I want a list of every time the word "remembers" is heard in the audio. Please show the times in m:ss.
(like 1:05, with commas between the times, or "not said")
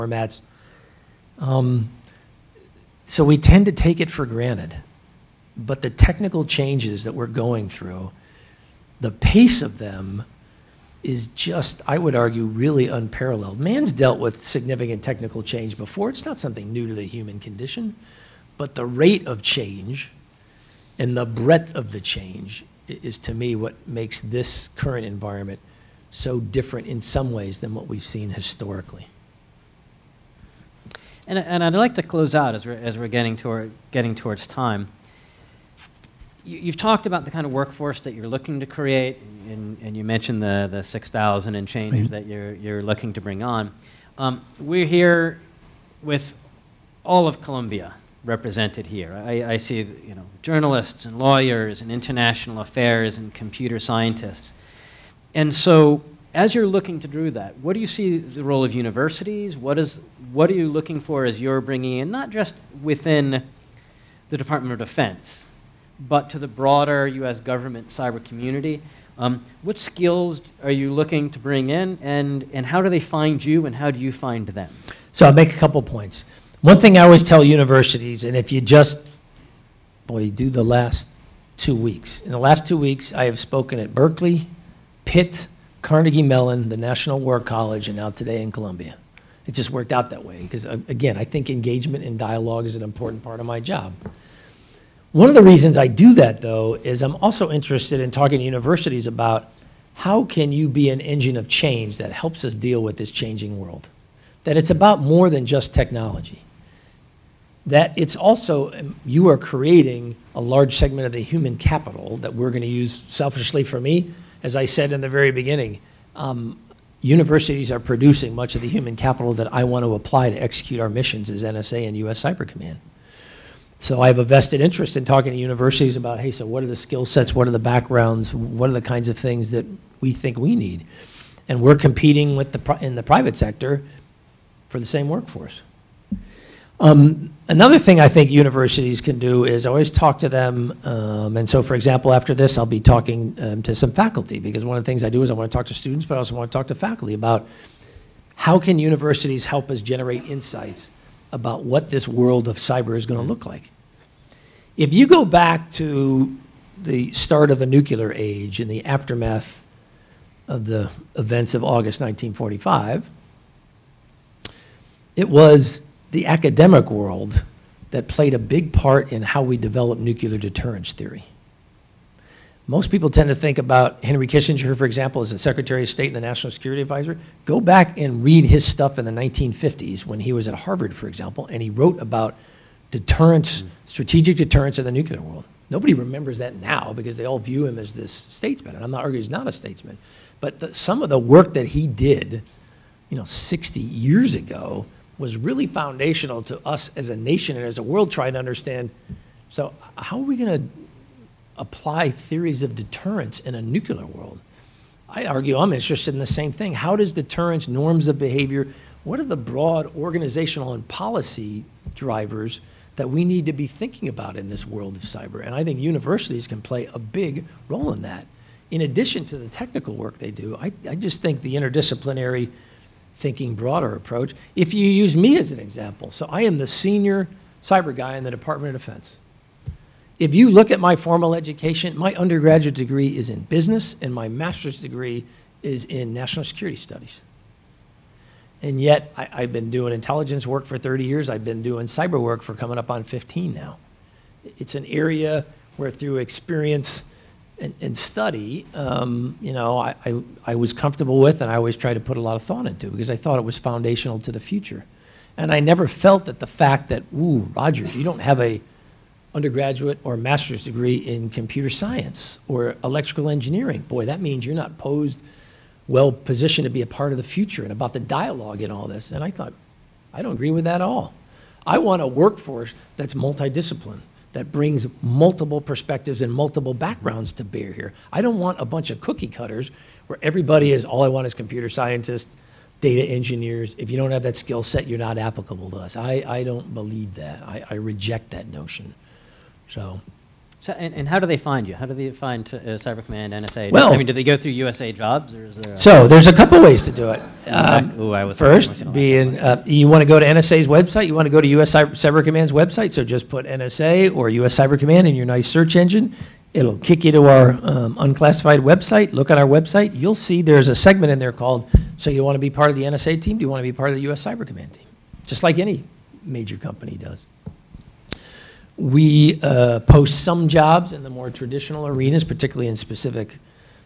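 3:05.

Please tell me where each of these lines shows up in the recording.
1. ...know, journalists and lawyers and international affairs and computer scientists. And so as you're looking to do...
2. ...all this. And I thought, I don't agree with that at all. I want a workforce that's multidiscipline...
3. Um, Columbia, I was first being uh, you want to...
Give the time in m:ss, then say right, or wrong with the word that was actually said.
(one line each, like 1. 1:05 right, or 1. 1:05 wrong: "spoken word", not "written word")
1. 0:50 right
2. 4:28 right
3. 4:57 wrong: "Ooh", not "Columbia".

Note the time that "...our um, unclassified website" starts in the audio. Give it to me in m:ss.
5:07.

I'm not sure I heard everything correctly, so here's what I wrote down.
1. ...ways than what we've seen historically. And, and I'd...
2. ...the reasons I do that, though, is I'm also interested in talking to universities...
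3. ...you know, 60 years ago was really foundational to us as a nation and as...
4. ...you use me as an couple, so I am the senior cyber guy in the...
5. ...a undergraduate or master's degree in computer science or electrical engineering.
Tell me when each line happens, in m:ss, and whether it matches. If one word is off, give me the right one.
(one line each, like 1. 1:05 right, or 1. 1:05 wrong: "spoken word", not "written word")
1. 0:27 right
2. 1:35 right
3. 3:13 right
4. 3:44 wrong: "example", not "couple"
5. 4:18 right.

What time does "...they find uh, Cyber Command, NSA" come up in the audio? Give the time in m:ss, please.
4:51.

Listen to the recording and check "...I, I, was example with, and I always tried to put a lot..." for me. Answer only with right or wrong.
wrong.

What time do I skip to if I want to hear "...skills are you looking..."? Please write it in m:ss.
1:09.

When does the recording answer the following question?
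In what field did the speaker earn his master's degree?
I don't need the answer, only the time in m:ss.
3:56.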